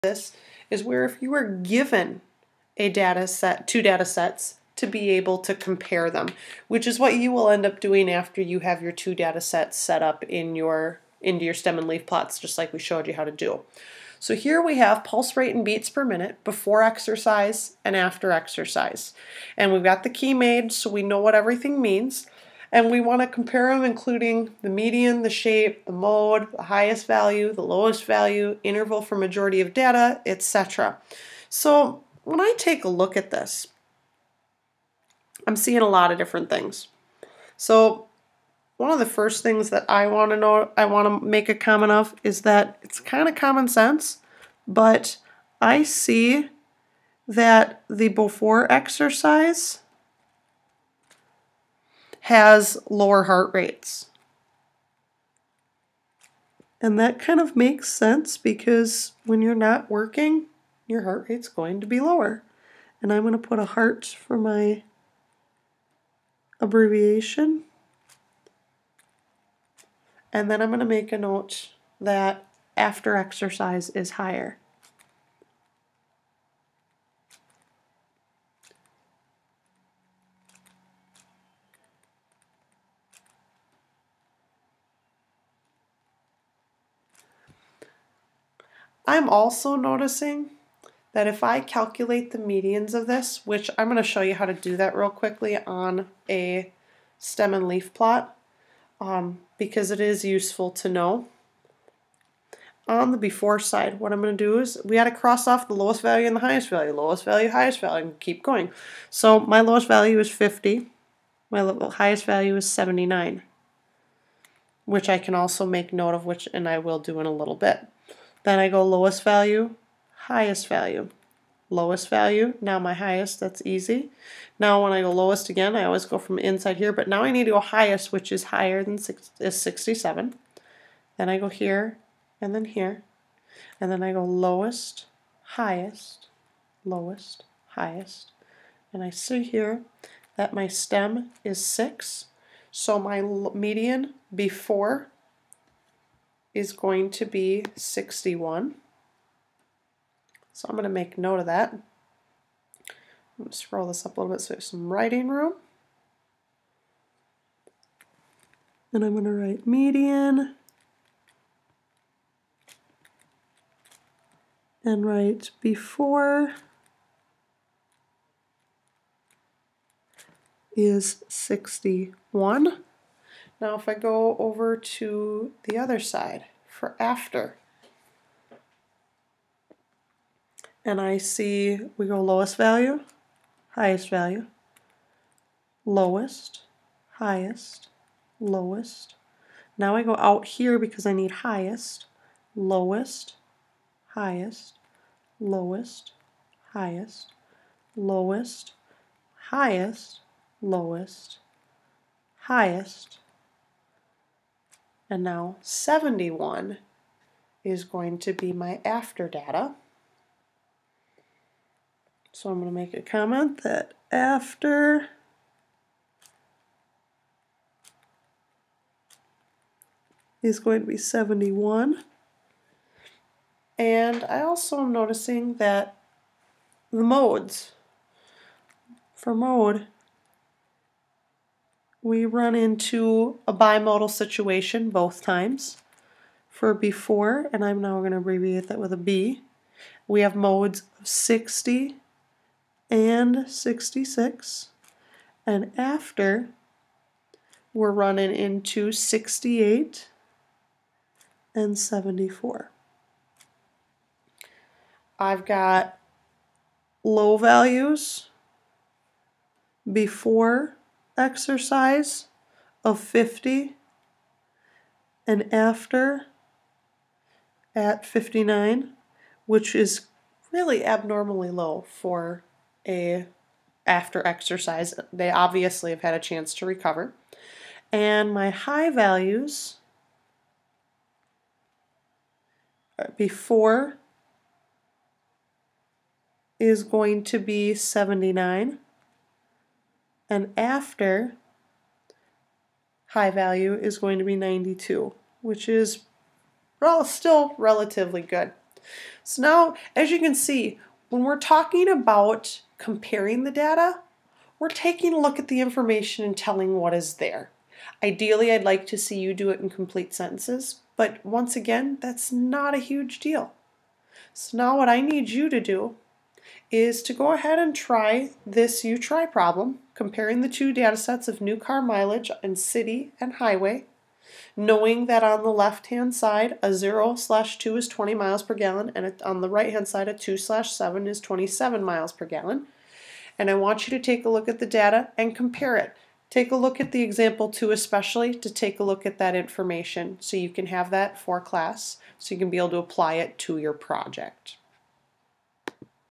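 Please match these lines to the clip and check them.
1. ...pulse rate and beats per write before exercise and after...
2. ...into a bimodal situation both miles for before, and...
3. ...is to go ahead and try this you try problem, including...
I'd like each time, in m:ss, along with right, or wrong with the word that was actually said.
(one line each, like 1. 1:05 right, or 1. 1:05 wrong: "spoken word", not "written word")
1. 0:15 wrong: "minute", not "write"
2. 3:52 wrong: "times", not "miles"
3. 5:16 wrong: "comparing", not "including".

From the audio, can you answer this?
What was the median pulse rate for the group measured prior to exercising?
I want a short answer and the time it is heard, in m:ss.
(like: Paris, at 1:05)
61, at 2:22.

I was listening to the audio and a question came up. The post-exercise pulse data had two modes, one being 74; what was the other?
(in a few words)
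68.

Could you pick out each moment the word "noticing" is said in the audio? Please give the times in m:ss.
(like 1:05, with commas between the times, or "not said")
1:29, 3:44.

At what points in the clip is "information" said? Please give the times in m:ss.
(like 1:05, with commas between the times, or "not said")
5:05, 5:39.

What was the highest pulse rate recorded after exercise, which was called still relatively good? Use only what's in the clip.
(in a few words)
92.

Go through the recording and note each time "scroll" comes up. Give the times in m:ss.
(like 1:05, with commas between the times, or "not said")
2:33.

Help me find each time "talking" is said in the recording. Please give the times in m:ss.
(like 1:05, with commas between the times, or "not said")
5:01.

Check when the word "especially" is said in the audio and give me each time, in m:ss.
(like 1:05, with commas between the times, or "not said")
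5:37.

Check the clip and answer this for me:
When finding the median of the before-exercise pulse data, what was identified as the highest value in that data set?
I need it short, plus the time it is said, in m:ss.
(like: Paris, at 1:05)
79, at 1:51.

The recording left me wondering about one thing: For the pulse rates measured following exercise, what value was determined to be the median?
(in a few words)
71.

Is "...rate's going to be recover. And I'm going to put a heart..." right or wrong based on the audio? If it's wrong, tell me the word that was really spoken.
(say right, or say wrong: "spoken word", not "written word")
wrong: "lower", not "recover".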